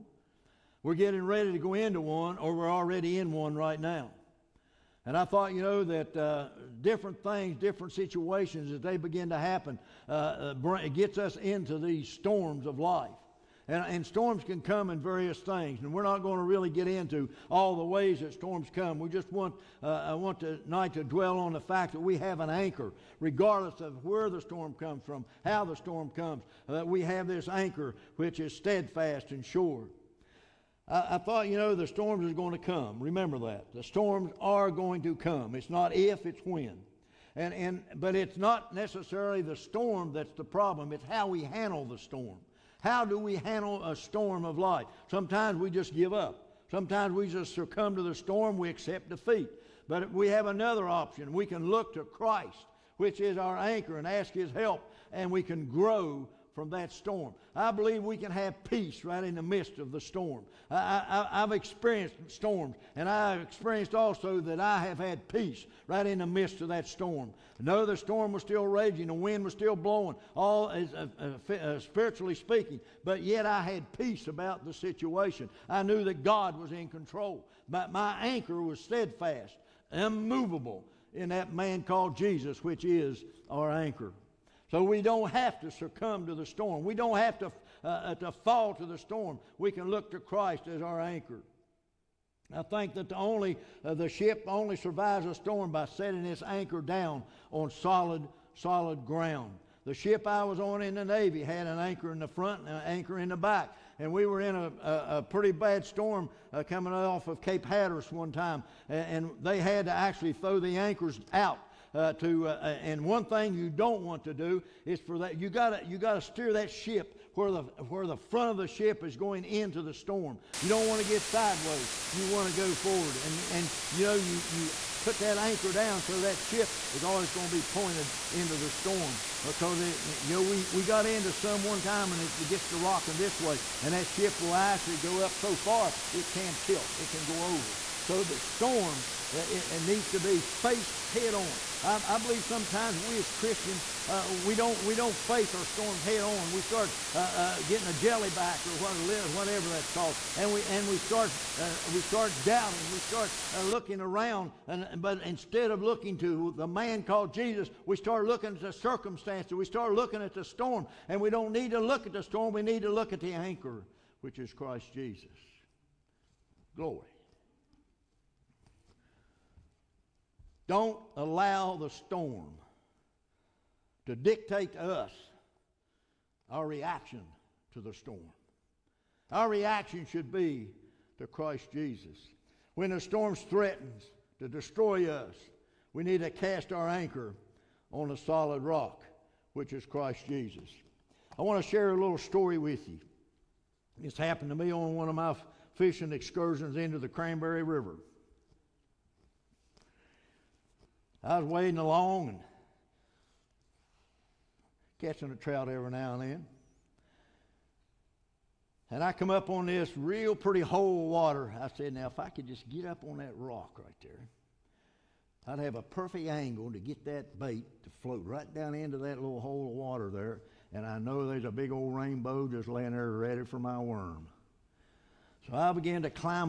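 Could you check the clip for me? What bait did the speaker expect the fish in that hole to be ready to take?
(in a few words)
Worm.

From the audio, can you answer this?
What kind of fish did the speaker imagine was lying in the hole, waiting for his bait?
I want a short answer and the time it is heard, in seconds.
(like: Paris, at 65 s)
Rainbow, at 221 s.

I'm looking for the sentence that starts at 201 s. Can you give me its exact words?
I was wading along and catching a trout every now and then.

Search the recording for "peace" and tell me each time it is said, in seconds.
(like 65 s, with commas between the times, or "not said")
58 s, 65 s, 73 s.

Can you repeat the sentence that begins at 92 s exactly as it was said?
I think that the only uh, the ship only survives a storm by setting its anchor down on solid solid ground.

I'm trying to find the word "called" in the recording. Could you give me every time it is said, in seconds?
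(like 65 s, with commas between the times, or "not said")
81 s, 149 s, 157 s.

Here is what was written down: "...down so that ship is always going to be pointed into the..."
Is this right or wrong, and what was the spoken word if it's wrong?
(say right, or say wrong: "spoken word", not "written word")
right.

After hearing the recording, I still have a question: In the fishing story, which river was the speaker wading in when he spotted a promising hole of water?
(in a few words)
Cranberry River.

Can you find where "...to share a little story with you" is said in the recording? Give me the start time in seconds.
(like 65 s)
191 s.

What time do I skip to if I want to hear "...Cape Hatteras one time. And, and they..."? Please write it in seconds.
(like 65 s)
107 s.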